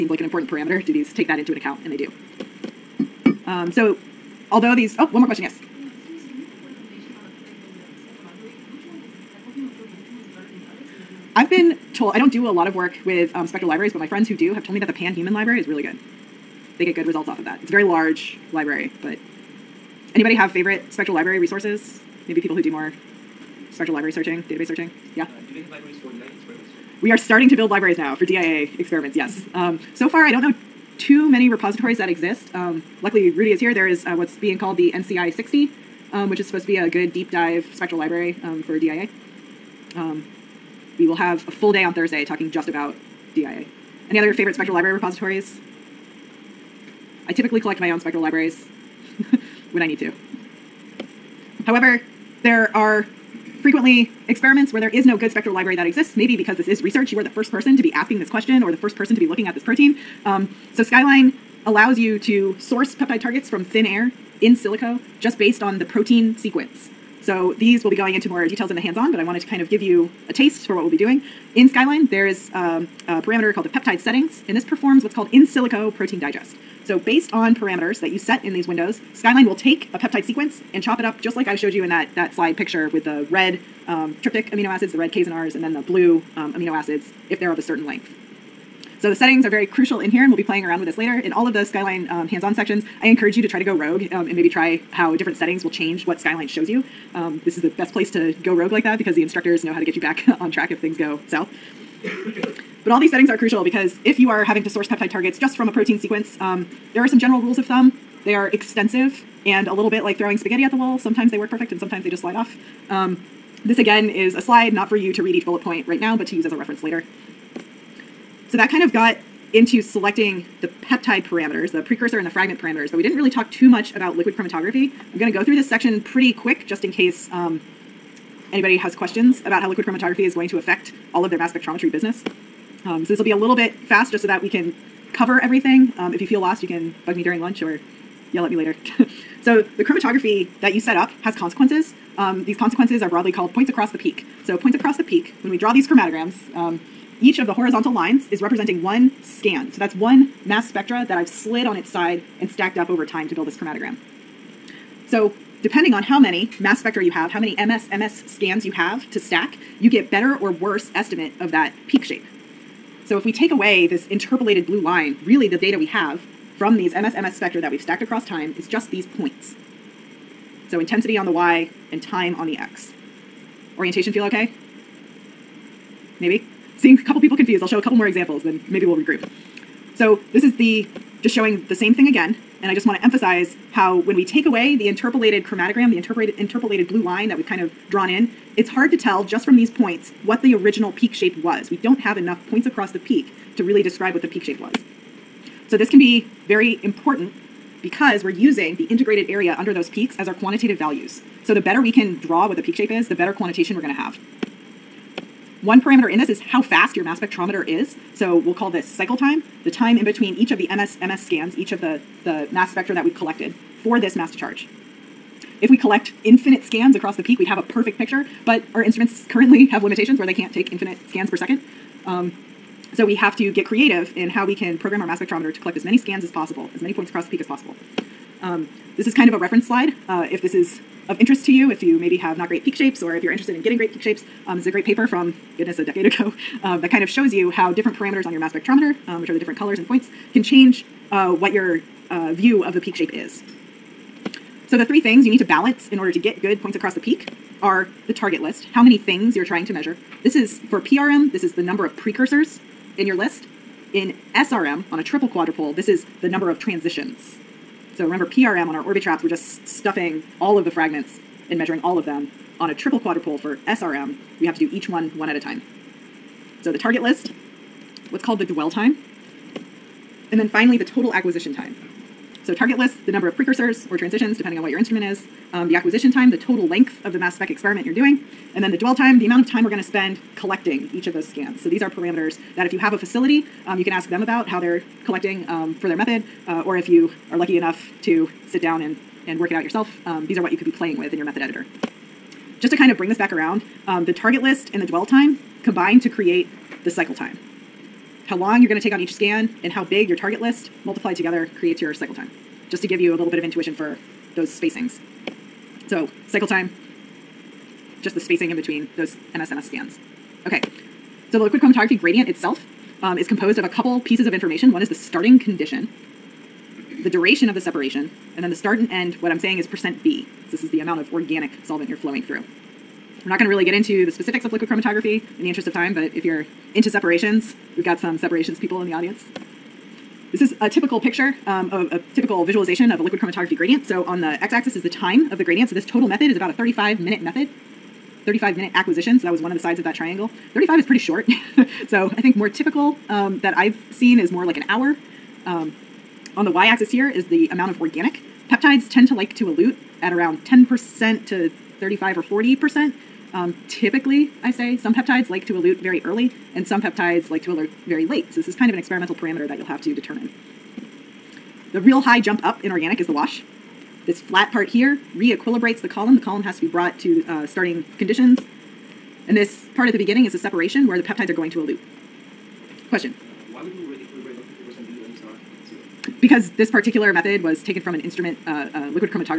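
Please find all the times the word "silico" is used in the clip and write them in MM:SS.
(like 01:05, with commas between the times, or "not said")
01:04, 01:15.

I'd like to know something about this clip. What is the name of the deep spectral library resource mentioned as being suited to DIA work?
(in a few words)
NCI 60.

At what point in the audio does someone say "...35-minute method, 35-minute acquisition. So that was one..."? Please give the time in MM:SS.
05:36.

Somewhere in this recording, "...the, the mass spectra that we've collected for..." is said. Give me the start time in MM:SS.
03:31.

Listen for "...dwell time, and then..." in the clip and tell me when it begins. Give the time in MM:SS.
04:28.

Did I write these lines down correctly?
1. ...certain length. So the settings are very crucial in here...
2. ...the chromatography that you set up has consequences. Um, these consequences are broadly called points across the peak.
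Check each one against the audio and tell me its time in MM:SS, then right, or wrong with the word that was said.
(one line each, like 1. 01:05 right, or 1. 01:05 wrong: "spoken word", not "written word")
1. 01:27 right
2. 02:19 right.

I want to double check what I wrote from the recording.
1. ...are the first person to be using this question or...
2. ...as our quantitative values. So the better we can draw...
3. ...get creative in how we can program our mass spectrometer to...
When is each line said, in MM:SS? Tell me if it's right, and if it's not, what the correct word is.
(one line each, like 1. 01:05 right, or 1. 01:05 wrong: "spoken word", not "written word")
1. 00:57 wrong: "asking", not "using"
2. 03:20 right
3. 03:43 right.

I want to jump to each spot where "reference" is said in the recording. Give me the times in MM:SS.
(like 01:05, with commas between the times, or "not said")
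01:56, 03:49.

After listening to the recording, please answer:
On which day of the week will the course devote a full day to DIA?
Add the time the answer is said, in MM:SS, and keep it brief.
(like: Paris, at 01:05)
Thursday, at 00:41.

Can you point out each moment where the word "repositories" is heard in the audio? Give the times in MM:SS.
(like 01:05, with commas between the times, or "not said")
00:31, 00:44.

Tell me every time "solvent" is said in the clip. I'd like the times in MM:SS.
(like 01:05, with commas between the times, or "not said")
05:21.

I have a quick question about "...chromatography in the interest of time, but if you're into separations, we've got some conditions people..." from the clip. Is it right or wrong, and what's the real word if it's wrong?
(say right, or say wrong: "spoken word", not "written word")
wrong: "separations", not "conditions".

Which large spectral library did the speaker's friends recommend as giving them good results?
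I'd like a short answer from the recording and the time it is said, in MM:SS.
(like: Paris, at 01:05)
Pan-Human library, at 00:14.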